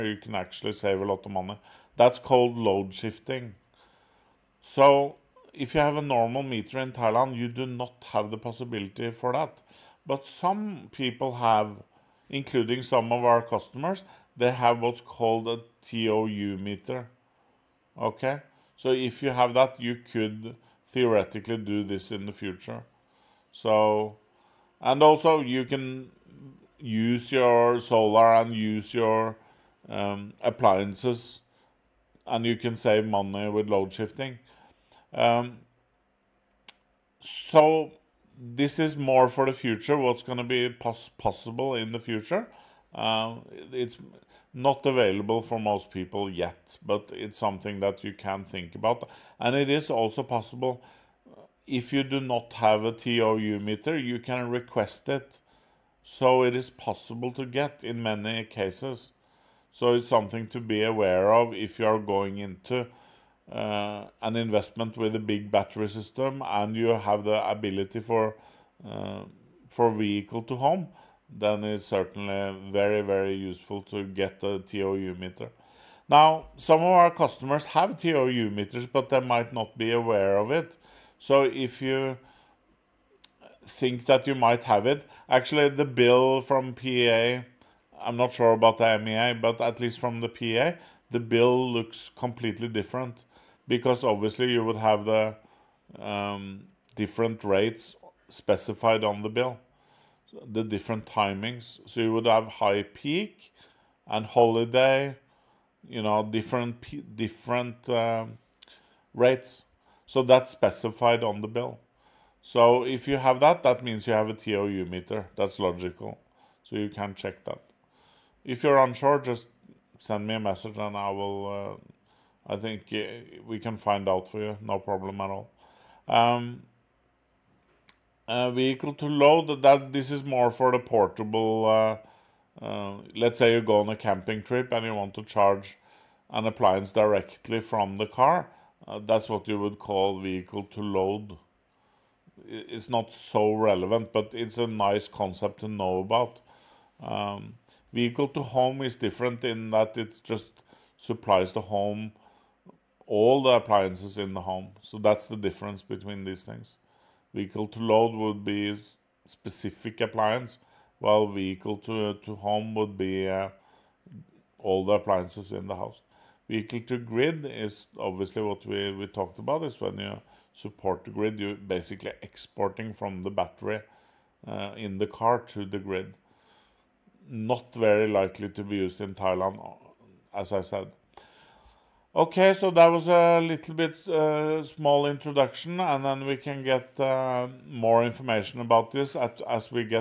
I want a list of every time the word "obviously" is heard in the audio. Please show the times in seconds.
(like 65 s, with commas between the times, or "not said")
94 s, 167 s.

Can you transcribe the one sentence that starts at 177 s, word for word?
Not very likely to be used in Thailand, uh, as I said.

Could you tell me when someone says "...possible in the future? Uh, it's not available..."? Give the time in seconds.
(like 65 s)
41 s.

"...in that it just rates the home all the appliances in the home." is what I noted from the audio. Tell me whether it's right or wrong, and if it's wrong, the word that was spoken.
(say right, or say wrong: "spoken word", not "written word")
wrong: "supplies", not "rates".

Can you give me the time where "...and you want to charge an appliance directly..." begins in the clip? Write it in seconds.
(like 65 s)
134 s.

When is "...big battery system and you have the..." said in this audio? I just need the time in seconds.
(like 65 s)
65 s.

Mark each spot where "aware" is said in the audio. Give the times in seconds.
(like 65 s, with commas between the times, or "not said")
60 s, 79 s.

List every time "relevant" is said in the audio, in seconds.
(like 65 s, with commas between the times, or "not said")
143 s.